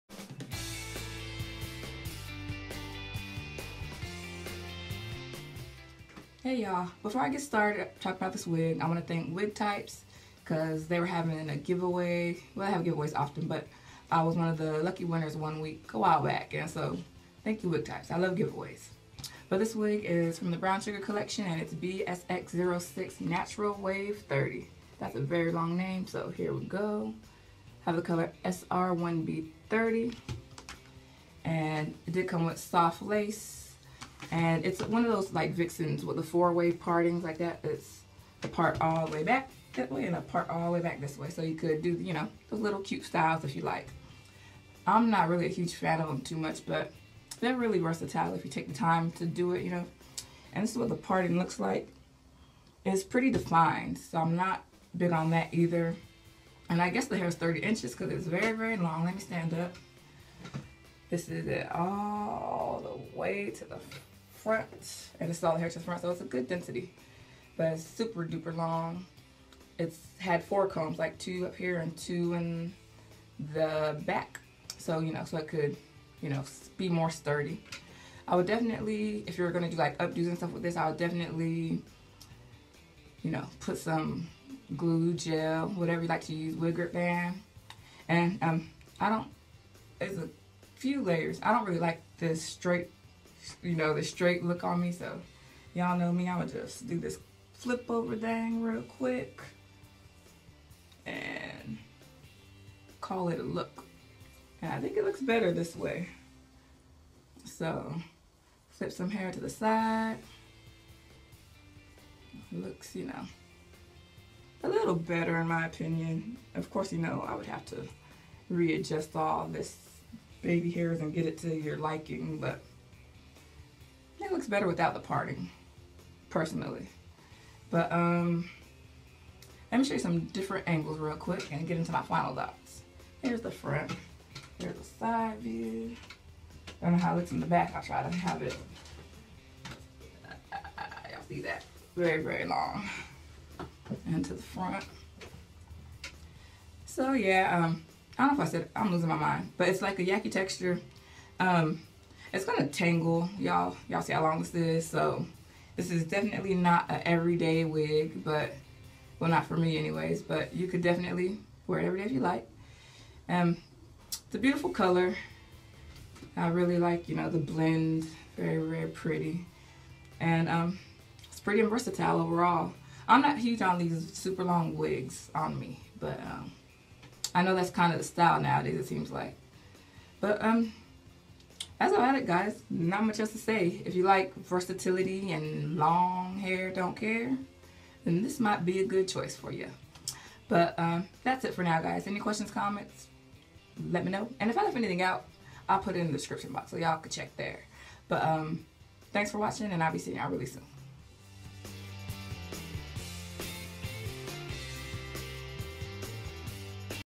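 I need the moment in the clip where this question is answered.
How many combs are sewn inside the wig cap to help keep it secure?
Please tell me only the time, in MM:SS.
01:10.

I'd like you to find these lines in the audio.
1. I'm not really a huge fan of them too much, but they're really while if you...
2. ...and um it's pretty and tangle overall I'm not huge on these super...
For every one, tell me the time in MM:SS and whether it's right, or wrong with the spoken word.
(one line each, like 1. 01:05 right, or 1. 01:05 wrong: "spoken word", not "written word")
1. 00:44 wrong: "versatile", not "while"
2. 02:50 wrong: "versatile", not "tangle".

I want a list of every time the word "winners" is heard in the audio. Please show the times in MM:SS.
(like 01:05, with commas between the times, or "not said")
00:15.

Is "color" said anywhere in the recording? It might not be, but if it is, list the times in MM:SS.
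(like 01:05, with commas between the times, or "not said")
00:28, 02:44.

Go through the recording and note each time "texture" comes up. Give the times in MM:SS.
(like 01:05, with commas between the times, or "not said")
02:30.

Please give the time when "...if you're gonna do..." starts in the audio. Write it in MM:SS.
01:19.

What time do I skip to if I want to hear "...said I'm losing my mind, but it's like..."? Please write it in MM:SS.
02:28.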